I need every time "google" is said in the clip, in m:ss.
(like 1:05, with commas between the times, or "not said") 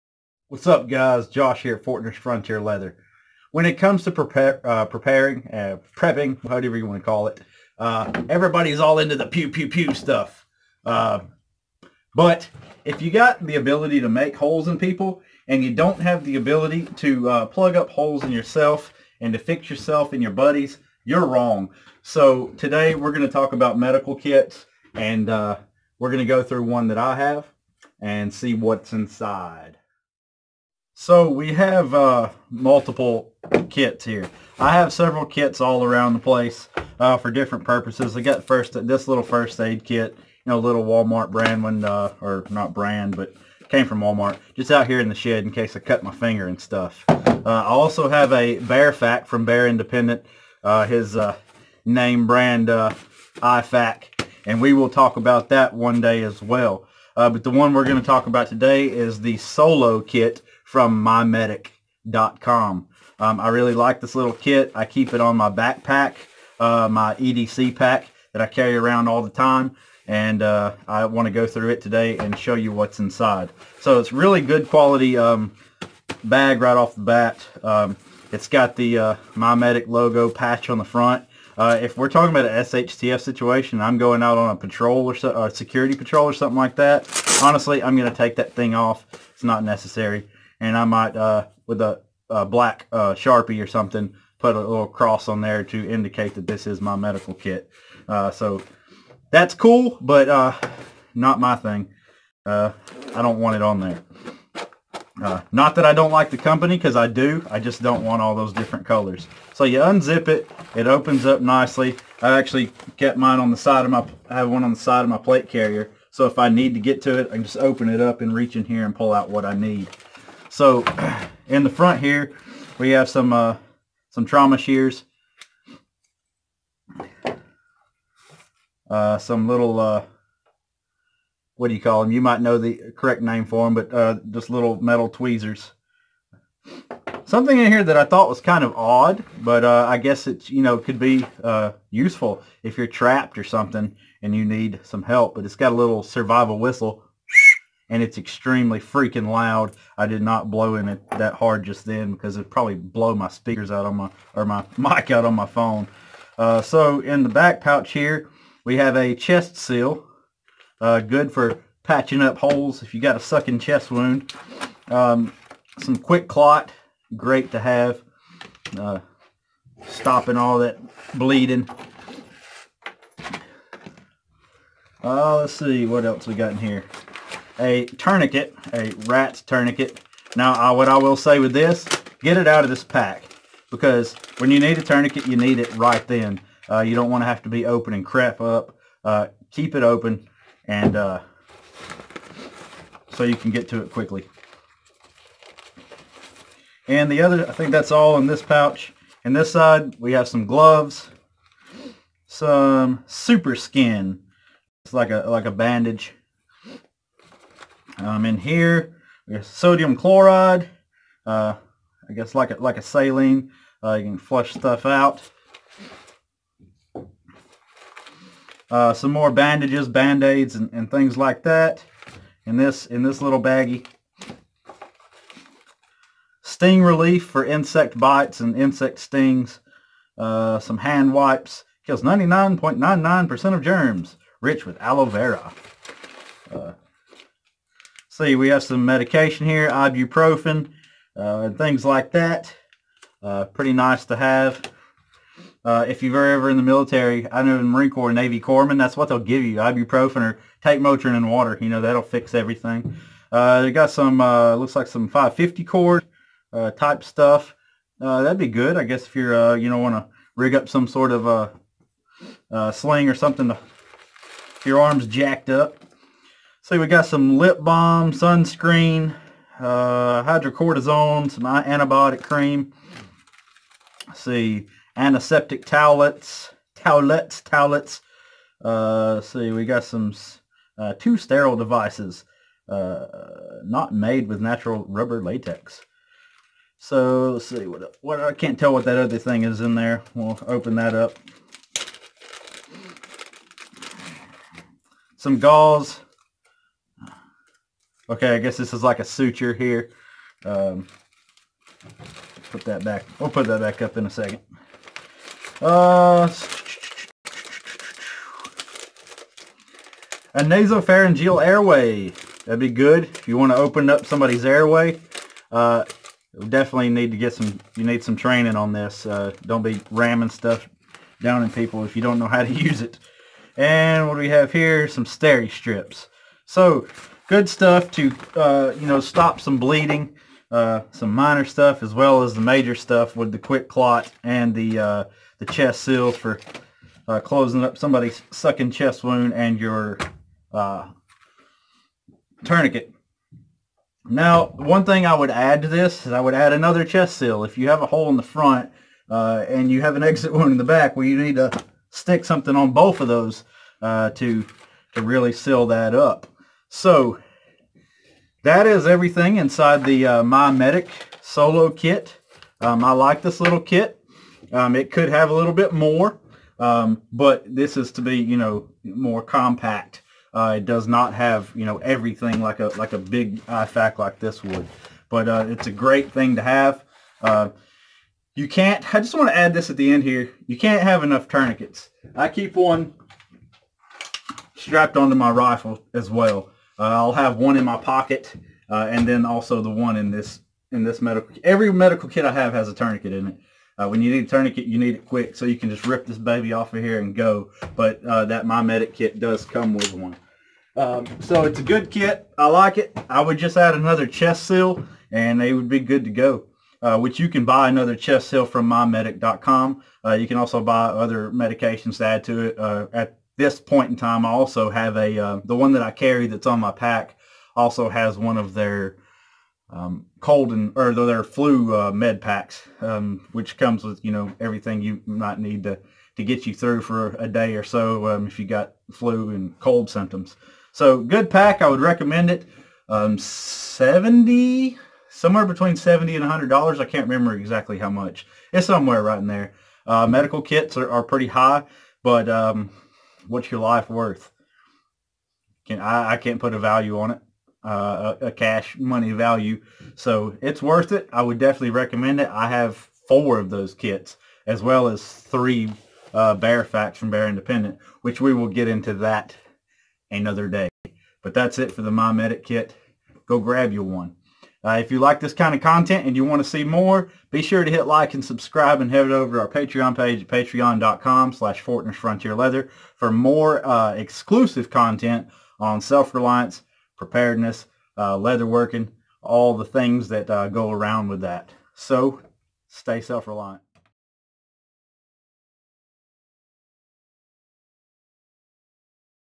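not said.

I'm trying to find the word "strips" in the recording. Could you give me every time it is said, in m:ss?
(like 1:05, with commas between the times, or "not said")
5:25.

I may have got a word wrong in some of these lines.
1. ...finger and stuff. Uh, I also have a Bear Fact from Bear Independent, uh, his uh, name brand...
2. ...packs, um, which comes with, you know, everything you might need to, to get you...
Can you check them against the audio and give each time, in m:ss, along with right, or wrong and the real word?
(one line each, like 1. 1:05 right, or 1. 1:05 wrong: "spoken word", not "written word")
1. 0:46 right
2. 7:02 right.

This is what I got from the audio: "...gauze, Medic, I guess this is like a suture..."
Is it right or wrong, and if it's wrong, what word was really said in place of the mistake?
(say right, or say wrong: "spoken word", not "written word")
wrong: "Okay", not "Medic".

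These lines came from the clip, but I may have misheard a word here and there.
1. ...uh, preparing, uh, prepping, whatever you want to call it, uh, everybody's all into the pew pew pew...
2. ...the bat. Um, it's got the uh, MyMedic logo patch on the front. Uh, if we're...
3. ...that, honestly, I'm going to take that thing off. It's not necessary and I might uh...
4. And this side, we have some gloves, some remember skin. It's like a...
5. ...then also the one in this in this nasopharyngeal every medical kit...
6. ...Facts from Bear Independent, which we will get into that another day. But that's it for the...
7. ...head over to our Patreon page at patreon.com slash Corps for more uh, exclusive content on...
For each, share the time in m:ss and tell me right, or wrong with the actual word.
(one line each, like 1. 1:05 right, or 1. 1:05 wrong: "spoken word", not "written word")
1. 0:04 right
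2. 1:16 right
3. 1:26 right
4. 3:19 wrong: "super", not "remember"
5. 6:29 wrong: "medical", not "nasopharyngeal"
6. 7:36 right
7. 7:48 wrong: "Leather", not "Corps".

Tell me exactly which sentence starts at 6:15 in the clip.
But uh, it's a great thing to have.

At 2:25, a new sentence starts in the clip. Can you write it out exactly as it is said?
But it's got a little survival whistle and it's extremely freaking loud.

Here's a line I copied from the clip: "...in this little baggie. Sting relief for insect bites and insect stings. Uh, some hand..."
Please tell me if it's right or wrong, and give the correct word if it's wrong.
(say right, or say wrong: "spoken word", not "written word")
right.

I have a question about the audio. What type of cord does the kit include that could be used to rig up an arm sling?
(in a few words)
550 cord.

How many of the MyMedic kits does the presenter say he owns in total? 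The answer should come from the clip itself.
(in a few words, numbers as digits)
4.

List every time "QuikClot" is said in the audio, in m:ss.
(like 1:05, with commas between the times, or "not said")
2:45, 5:33.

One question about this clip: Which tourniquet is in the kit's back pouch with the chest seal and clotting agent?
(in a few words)
RATS.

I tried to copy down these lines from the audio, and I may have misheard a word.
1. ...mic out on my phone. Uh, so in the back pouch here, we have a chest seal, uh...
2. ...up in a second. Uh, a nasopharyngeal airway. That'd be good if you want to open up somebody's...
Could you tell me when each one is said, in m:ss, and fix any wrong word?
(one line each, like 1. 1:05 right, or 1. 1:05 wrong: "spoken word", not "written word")
1. 2:34 right
2. 5:03 right.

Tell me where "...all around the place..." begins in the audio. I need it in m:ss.
0:35.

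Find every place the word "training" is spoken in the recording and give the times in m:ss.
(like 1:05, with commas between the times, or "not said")
5:18.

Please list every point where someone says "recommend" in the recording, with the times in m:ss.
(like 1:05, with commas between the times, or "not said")
7:11, 7:31.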